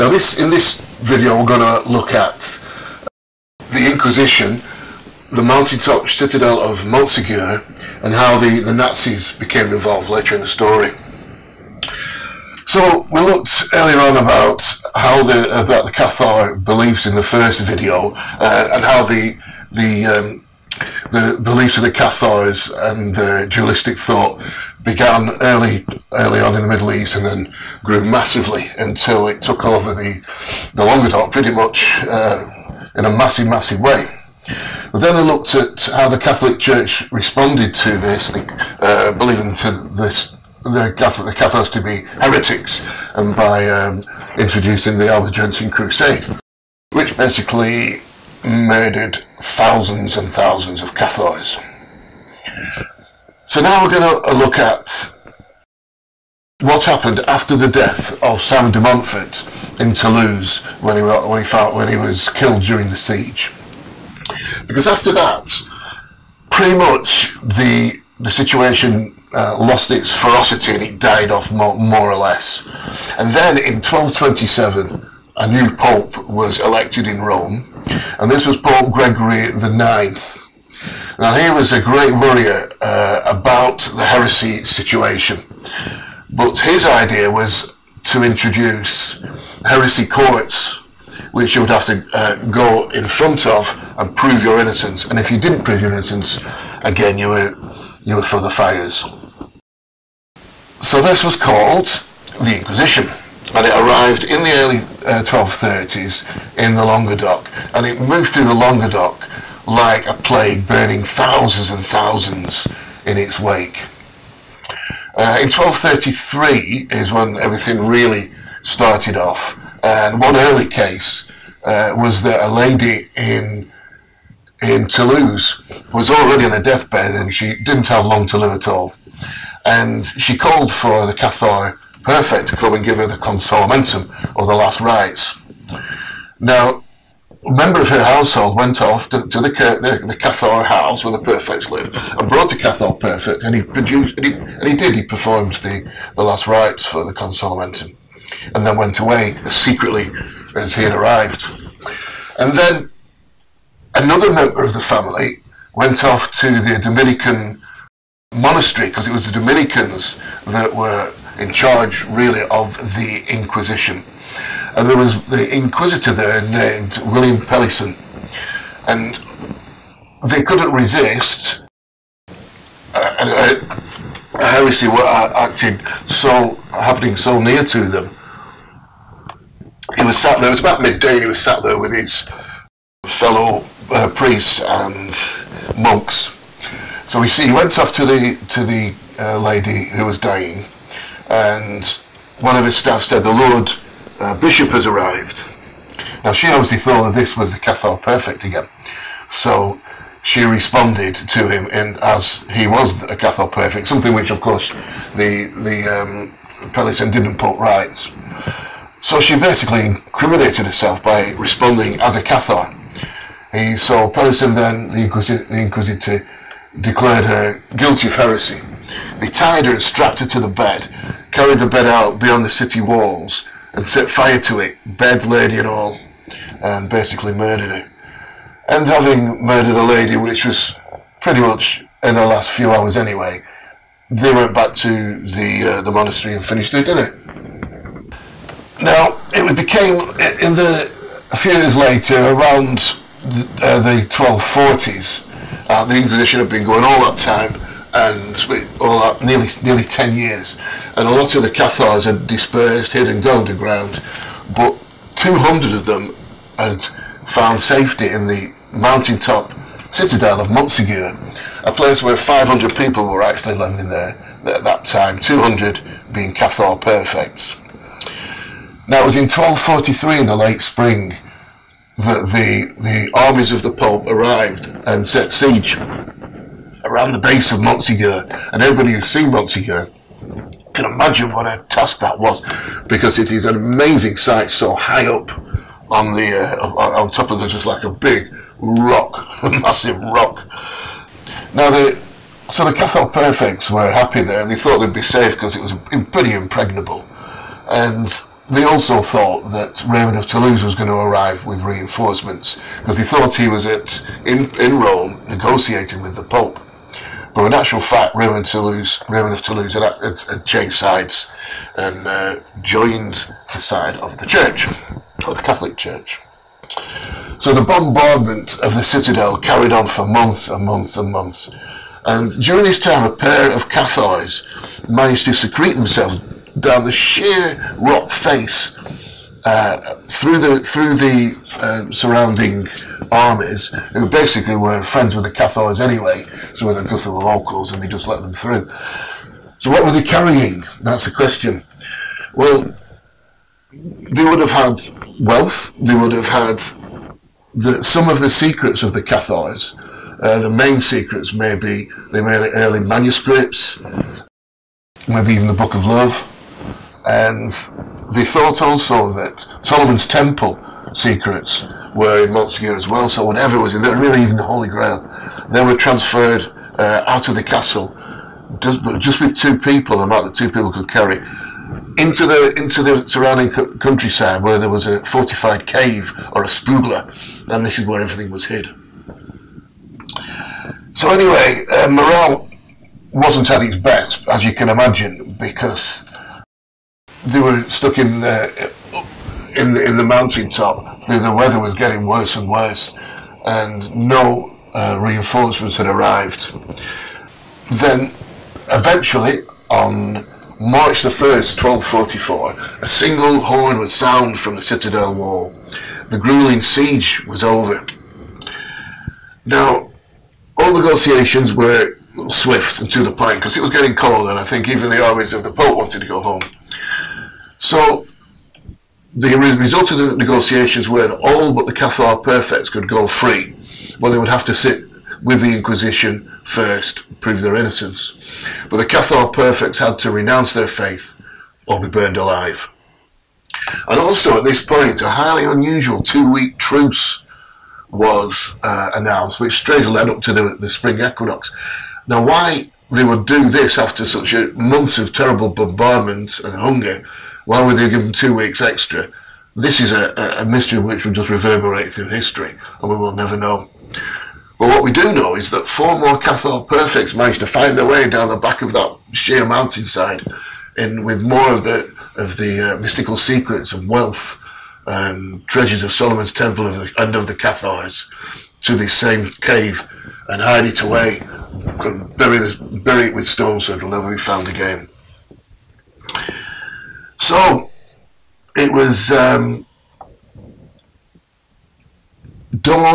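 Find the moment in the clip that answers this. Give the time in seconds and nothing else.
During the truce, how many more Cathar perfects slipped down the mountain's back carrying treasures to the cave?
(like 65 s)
455 s.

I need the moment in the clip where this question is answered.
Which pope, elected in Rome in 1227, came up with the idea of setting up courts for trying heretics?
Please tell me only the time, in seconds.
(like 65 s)
78 s.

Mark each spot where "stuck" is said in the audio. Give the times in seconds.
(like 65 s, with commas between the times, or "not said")
387 s.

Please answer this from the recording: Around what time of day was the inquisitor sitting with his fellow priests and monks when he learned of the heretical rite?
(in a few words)
midday.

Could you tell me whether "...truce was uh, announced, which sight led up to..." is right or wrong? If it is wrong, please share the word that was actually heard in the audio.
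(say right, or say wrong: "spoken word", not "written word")
wrong: "straight", not "sight".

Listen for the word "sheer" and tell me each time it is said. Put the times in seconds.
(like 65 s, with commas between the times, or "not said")
326 s, 459 s.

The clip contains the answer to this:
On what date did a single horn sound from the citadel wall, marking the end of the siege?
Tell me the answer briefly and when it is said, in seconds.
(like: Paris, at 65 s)
March 1, 1244, at 400 s.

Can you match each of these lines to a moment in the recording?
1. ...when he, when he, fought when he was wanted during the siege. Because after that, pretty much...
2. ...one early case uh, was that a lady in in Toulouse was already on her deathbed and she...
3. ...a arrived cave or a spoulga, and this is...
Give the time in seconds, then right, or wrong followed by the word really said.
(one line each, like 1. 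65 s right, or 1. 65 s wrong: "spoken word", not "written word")
1. 60 s wrong: "killed", not "wanted"
2. 120 s right
3. 374 s wrong: "fortified", not "arrived".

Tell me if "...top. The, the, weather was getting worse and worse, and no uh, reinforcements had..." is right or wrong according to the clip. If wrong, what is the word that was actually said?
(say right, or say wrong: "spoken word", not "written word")
right.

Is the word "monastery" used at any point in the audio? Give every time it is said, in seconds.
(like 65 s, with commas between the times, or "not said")
158 s, 235 s.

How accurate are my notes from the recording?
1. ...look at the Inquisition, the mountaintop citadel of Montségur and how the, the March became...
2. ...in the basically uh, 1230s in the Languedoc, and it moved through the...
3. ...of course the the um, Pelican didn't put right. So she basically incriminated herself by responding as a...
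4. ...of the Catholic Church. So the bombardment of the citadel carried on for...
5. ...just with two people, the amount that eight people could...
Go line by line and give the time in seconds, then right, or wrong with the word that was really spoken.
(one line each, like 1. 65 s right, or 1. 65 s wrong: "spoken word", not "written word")
1. 1 s wrong: "Nazis", not "March"
2. 104 s wrong: "early", not "basically"
3. 204 s right
4. 314 s right
5. 368 s wrong: "two", not "eight".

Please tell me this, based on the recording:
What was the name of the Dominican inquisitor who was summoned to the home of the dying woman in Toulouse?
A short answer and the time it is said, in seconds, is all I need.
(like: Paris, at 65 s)
William Pelhisson, at 167 s.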